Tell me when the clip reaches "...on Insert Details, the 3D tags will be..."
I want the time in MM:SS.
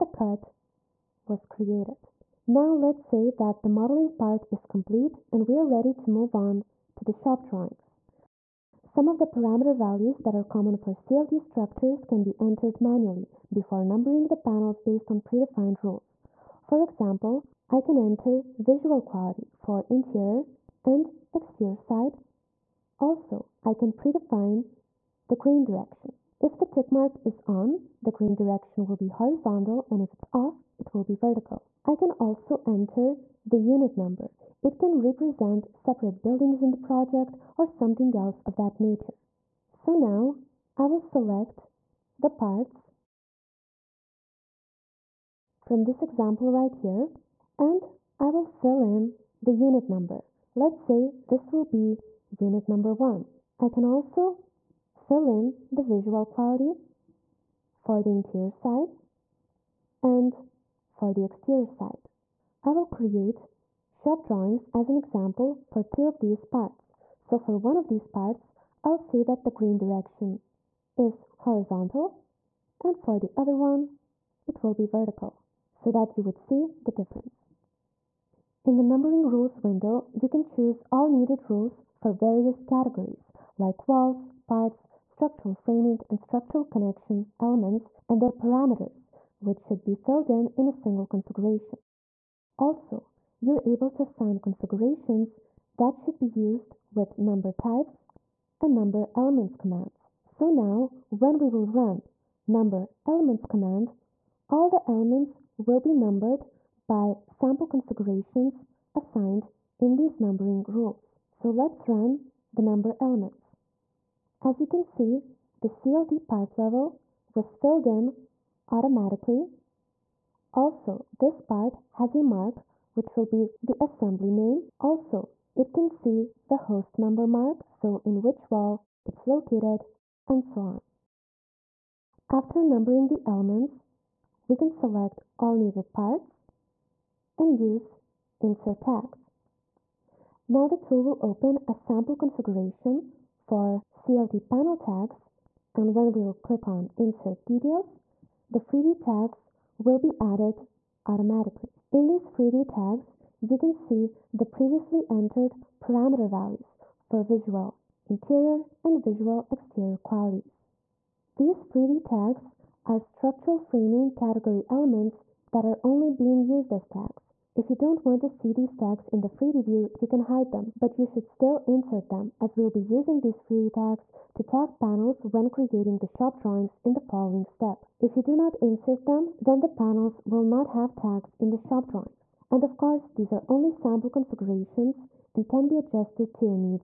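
02:26.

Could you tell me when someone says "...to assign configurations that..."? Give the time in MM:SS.
01:33.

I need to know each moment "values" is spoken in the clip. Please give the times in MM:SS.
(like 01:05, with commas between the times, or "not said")
00:09, 02:36.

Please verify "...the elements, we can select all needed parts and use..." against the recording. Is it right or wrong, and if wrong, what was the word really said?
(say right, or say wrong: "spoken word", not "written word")
right.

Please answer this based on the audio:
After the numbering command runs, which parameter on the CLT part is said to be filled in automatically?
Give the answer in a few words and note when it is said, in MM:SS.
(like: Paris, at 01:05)
CLT part level, at 01:55.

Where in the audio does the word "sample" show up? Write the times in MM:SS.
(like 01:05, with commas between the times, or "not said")
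01:47, 02:21, 03:03.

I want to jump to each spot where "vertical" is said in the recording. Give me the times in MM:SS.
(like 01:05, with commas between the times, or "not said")
00:31, 01:14.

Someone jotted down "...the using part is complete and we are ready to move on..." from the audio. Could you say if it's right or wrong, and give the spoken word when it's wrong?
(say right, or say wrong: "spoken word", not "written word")
wrong: "modeling", not "using".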